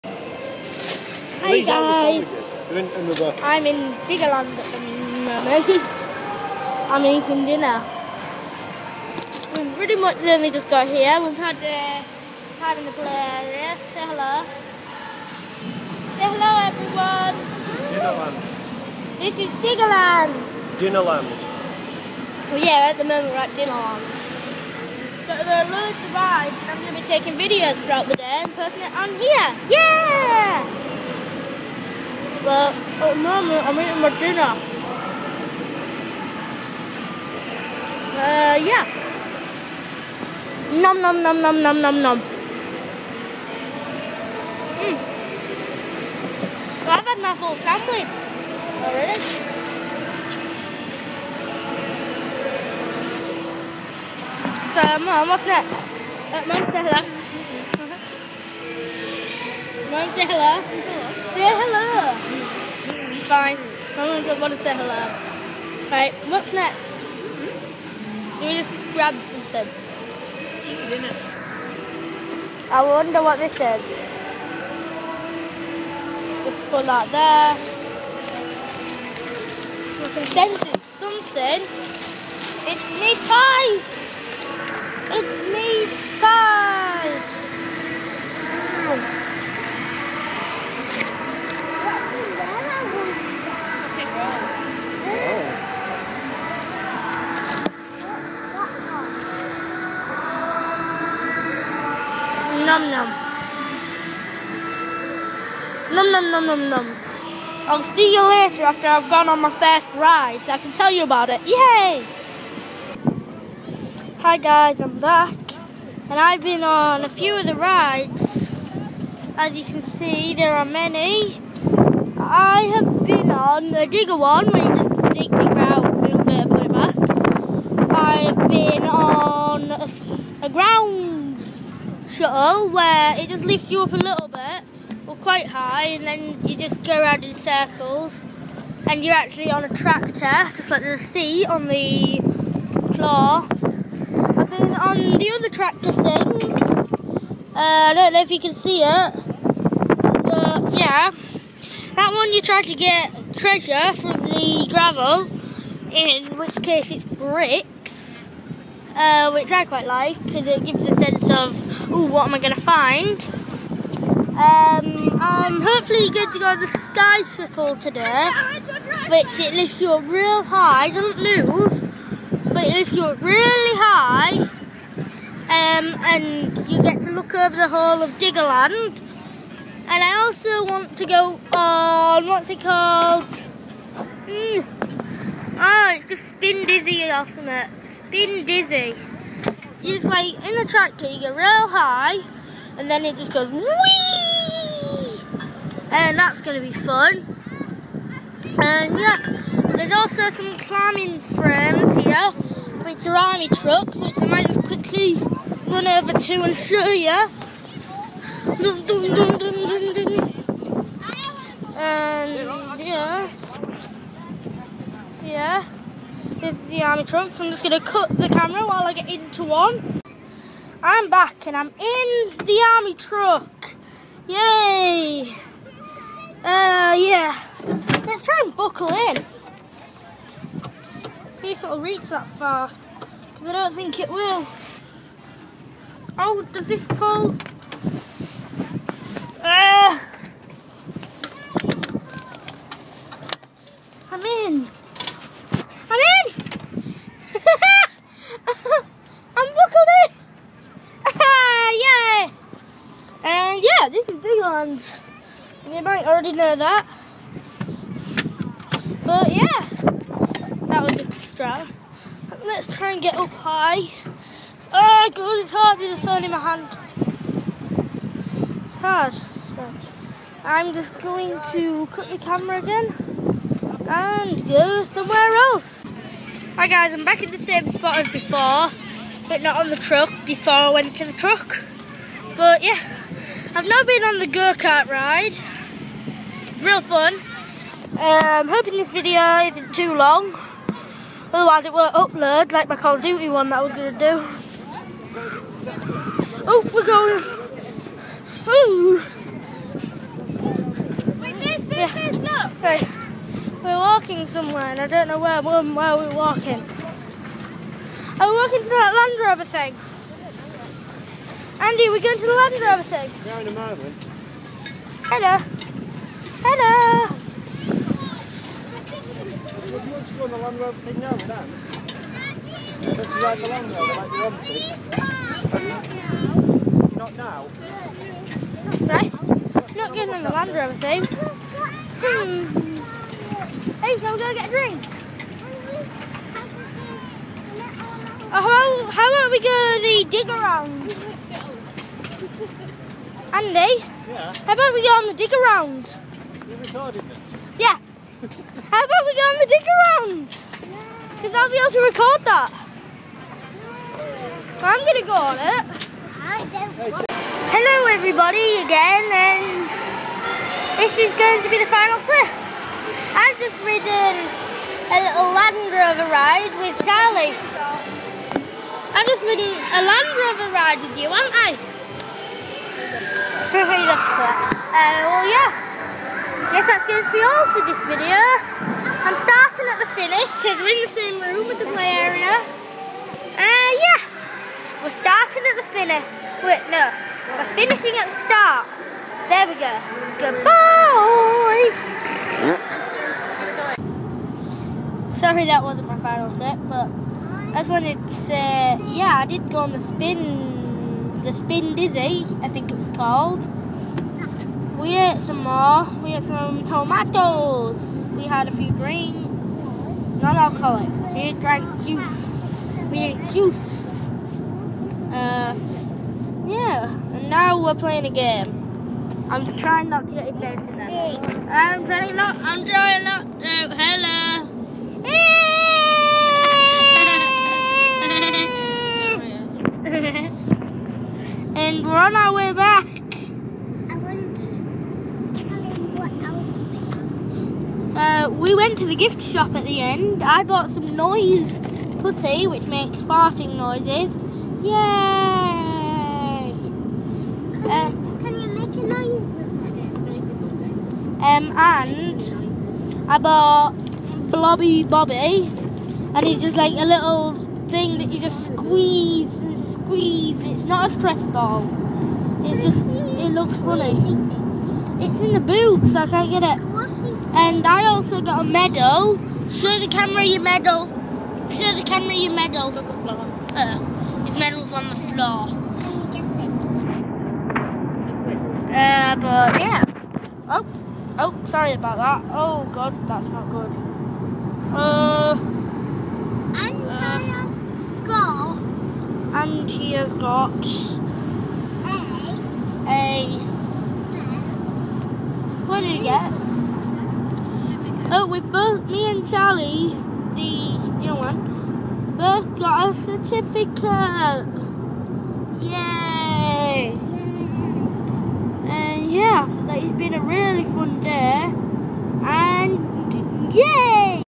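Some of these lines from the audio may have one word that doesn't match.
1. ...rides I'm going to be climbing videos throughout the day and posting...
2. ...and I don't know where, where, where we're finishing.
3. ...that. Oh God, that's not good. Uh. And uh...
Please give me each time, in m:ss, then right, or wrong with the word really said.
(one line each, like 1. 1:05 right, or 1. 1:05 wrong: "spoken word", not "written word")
1. 0:26 wrong: "taking", not "climbing"
2. 5:04 wrong: "walking", not "finishing"
3. 8:01 right.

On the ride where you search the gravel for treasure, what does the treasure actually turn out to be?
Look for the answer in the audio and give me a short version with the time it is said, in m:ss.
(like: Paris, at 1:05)
Bricks, at 2:37.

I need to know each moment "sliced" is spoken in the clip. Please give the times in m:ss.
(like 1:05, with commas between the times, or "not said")
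not said.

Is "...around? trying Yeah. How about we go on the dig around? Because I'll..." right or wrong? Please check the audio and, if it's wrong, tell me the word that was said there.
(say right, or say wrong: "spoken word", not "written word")
wrong: "recording", not "trying".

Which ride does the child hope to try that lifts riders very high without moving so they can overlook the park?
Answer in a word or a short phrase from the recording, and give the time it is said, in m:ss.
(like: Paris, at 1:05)
Sky shuttle, at 2:46.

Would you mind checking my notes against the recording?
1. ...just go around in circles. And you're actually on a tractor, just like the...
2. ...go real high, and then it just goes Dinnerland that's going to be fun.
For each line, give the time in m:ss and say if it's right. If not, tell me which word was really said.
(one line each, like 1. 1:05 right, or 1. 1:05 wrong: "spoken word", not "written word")
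1. 2:16 right
2. 3:11 wrong: "And", not "Dinnerland".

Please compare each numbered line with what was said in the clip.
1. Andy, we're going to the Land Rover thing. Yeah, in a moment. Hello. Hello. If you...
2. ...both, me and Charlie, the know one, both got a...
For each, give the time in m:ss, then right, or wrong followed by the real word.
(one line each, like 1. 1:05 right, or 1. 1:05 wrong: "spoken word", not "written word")
1. 5:11 right
2. 8:18 right.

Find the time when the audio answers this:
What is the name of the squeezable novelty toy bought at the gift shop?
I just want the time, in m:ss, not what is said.
7:34.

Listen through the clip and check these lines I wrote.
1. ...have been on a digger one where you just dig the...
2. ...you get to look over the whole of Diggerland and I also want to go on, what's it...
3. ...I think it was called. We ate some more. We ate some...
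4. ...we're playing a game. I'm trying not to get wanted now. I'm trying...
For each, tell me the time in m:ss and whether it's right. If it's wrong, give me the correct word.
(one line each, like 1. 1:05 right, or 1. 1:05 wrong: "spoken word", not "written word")
1. 2:02 right
2. 2:56 right
3. 6:42 right
4. 6:57 wrong: "excited", not "wanted".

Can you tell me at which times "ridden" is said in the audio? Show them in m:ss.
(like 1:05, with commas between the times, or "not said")
6:03, 6:09.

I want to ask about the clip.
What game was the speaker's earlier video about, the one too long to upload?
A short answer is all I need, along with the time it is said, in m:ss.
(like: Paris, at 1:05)
Call of Duty, at 4:52.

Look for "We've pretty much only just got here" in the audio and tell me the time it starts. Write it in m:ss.
0:09.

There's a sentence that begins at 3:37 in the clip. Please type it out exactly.
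So I'm just going to cut the camera while I get into one.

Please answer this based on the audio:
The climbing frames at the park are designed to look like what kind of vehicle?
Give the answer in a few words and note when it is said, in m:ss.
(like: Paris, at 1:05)
Army trucks, at 3:23.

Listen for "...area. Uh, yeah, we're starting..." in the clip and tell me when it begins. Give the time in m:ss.
6:21.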